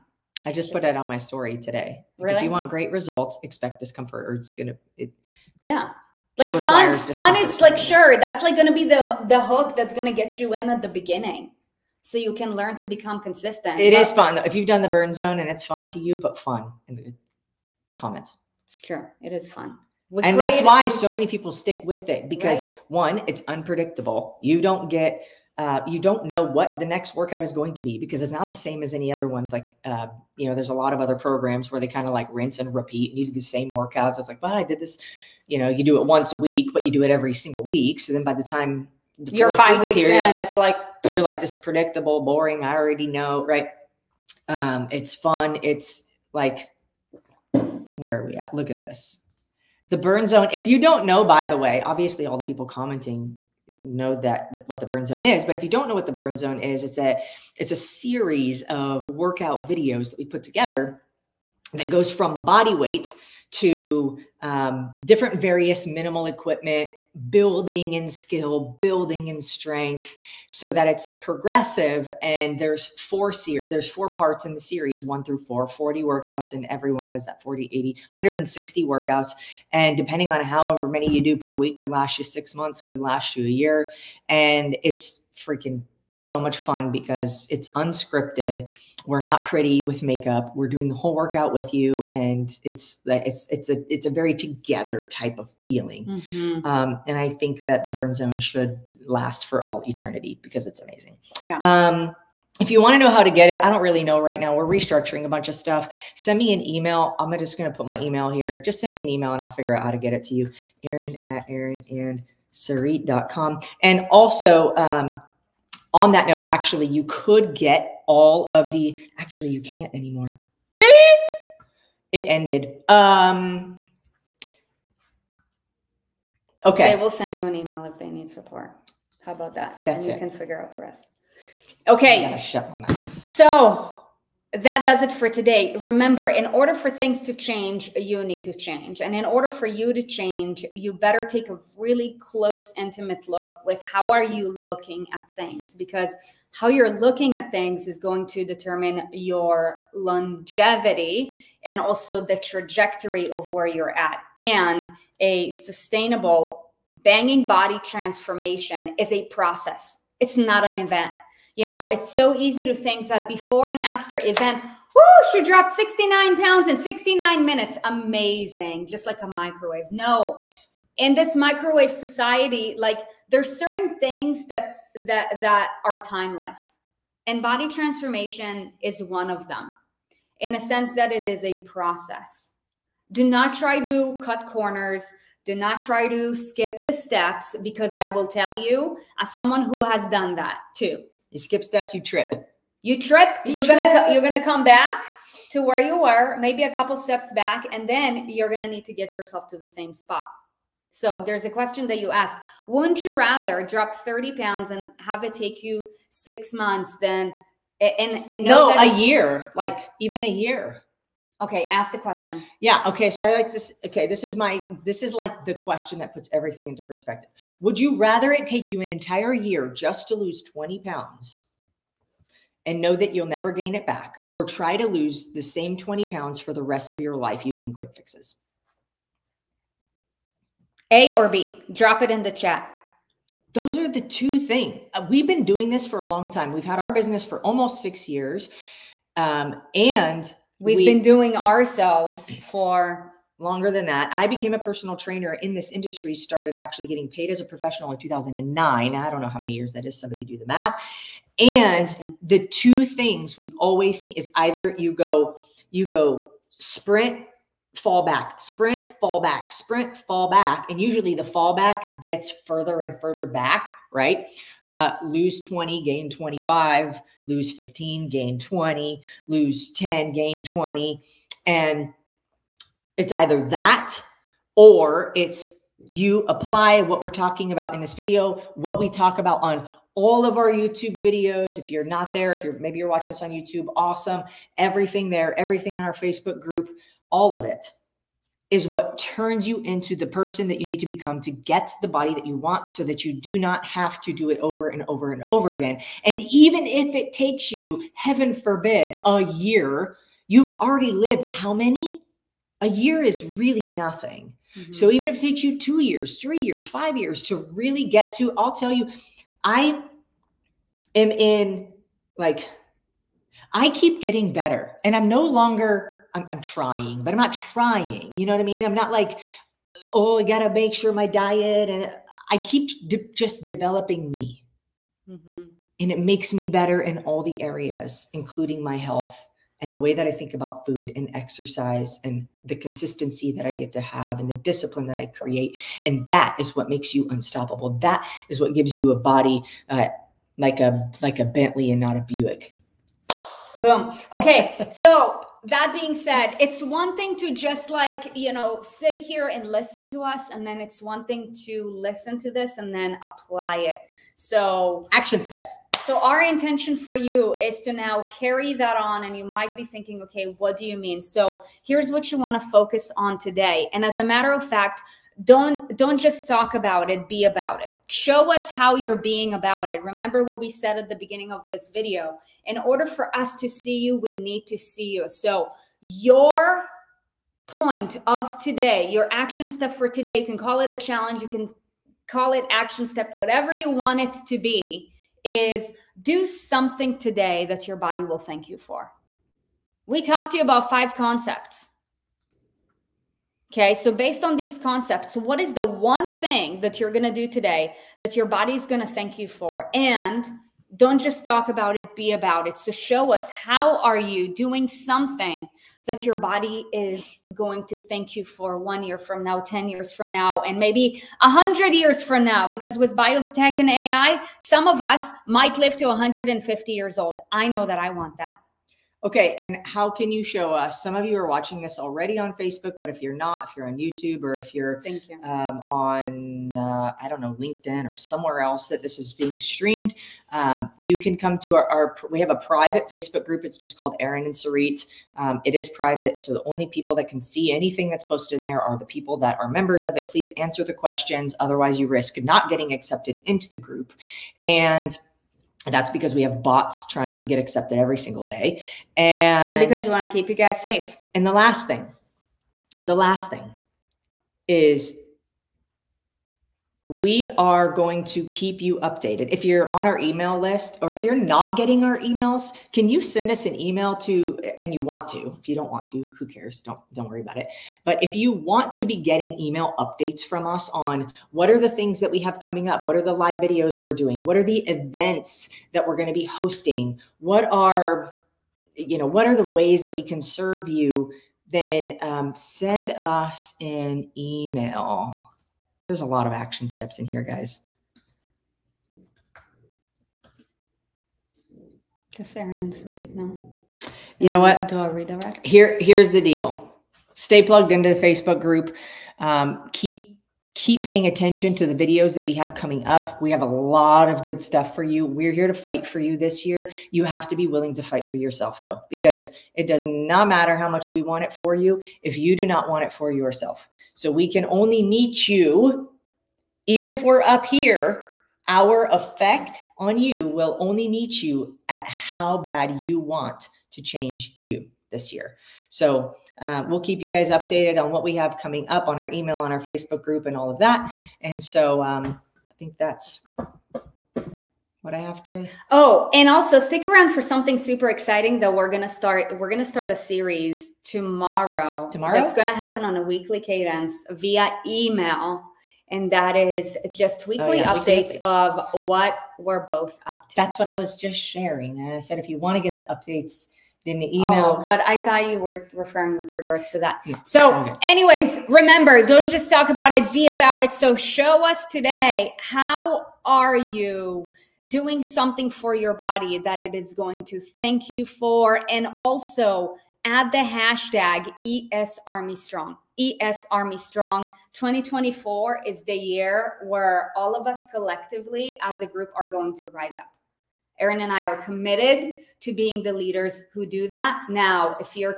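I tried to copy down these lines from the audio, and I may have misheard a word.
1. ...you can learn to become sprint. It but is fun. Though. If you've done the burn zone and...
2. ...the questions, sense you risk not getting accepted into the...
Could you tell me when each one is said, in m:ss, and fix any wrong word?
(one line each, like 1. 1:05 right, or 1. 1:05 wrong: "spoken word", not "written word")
1. 0:12 wrong: "consistent", not "sprint"
2. 7:20 wrong: "otherwise", not "sense".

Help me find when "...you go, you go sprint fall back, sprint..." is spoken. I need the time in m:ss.
4:14.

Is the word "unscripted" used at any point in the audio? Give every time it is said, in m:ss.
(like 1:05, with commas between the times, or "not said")
1:27.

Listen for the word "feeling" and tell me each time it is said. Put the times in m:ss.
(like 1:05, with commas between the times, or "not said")
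1:35.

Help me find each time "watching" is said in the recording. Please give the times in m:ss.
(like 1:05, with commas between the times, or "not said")
4:42, 7:01.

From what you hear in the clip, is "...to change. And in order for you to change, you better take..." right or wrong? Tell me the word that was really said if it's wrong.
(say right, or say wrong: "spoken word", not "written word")
right.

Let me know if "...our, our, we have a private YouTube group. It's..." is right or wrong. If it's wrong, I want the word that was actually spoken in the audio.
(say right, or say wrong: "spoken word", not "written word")
wrong: "Facebook", not "YouTube".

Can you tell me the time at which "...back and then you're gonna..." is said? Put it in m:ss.
3:17.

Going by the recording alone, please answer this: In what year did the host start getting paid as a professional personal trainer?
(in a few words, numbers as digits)
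2009.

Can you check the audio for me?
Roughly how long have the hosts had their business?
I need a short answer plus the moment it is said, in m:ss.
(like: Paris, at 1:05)
almost six years, at 3:57.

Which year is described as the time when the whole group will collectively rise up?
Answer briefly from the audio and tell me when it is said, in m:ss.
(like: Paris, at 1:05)
2024, at 9:34.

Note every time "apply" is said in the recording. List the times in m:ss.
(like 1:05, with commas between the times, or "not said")
4:36, 5:53.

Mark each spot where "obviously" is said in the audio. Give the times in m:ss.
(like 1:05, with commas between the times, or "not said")
0:51.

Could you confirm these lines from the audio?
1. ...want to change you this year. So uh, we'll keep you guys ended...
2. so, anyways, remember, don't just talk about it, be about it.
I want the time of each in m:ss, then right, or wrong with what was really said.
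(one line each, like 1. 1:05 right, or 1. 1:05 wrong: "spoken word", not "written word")
1. 8:42 wrong: "updated", not "ended"
2. 9:17 right.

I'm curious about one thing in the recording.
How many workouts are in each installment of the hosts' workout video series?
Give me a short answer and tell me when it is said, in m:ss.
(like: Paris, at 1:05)
40, at 1:15.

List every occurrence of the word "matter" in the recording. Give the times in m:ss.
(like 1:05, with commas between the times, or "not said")
6:04, 8:30.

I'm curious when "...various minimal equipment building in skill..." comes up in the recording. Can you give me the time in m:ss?
1:05.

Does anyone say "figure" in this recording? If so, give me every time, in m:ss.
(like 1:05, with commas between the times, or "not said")
1:49, 2:10.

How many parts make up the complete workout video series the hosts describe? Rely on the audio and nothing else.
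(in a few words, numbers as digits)
4.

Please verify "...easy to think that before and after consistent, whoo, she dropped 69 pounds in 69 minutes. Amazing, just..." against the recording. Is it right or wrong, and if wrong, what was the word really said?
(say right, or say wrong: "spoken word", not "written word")
wrong: "event", not "consistent".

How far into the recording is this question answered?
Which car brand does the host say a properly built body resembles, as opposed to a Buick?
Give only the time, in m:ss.
5:41.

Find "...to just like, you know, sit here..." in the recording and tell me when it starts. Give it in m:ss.
5:47.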